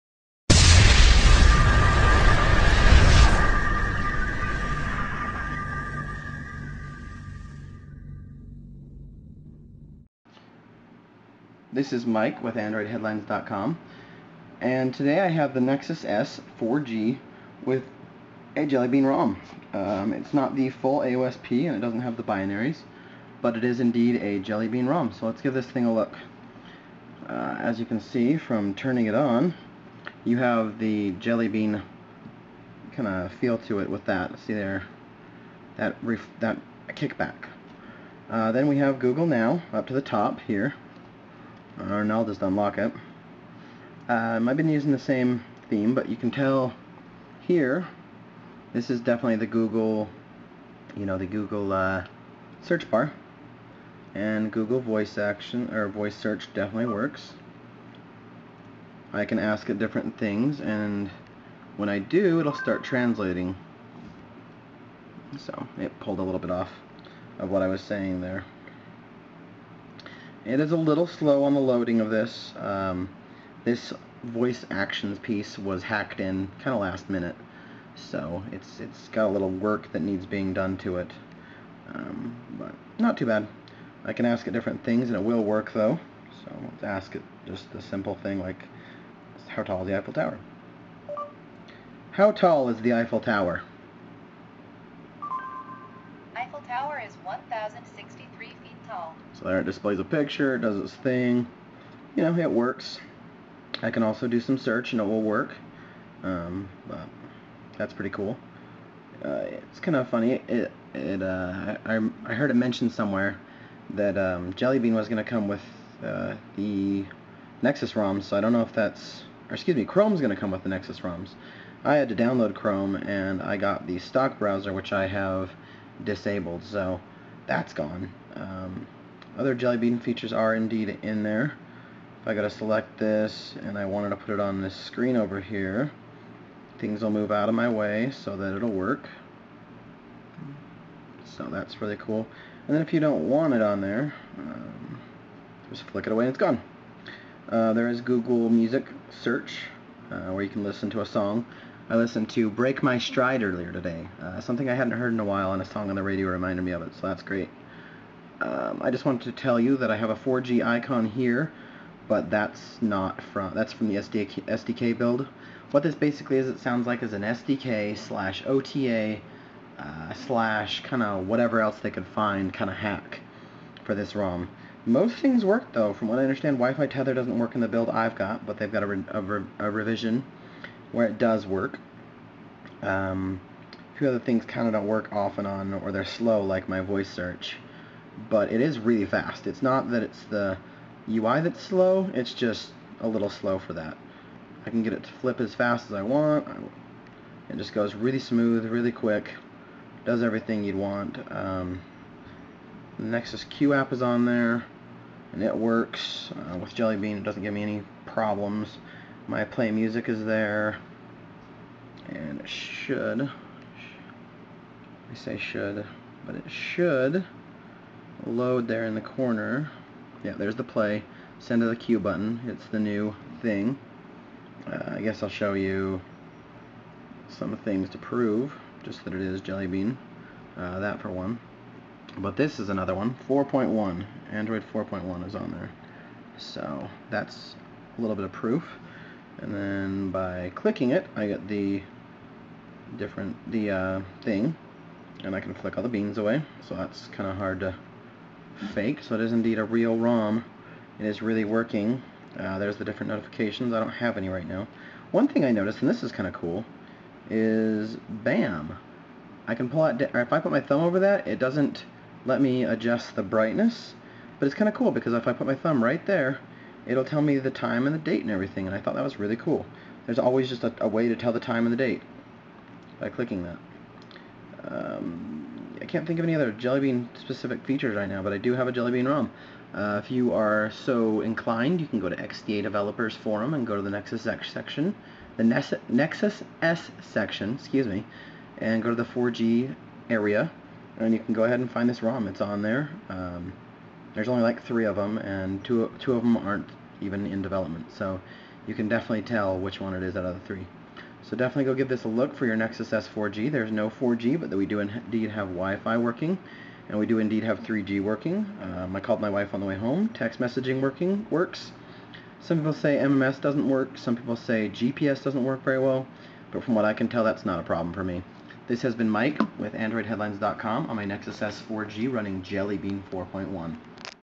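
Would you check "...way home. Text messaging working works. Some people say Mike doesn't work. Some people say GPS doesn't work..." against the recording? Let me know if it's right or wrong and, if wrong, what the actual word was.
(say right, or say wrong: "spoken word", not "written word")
wrong: "MMS", not "Mike".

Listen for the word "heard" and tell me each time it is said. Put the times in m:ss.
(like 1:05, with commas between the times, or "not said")
1:52, 2:34.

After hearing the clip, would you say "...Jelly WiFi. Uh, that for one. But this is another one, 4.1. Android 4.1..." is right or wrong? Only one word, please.
wrong.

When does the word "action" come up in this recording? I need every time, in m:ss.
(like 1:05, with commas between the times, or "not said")
0:55, 1:14.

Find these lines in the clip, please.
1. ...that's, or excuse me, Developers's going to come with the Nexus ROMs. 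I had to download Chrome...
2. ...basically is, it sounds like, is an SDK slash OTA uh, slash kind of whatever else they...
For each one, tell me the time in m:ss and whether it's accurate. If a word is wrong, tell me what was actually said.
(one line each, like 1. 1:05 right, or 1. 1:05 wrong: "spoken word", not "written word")
1. 1:58 wrong: "Chrome", not "Developers"
2. 2:45 right.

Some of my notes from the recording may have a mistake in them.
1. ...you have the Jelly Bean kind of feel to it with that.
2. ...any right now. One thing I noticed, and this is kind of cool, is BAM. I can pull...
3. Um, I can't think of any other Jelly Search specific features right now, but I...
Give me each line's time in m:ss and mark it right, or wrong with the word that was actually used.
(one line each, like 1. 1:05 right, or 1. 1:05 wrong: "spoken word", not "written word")
1. 0:30 right
2. 4:14 right
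3. 4:34 wrong: "Bean", not "Search".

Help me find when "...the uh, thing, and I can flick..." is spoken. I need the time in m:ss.
4:03.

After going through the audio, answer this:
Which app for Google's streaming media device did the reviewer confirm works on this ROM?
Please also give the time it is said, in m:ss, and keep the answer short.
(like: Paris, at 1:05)
Nexus Q app, at 3:22.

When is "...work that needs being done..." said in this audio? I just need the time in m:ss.
1:19.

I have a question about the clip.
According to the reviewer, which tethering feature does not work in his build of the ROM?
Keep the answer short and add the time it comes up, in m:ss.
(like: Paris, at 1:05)
Wi-Fi tether, at 2:56.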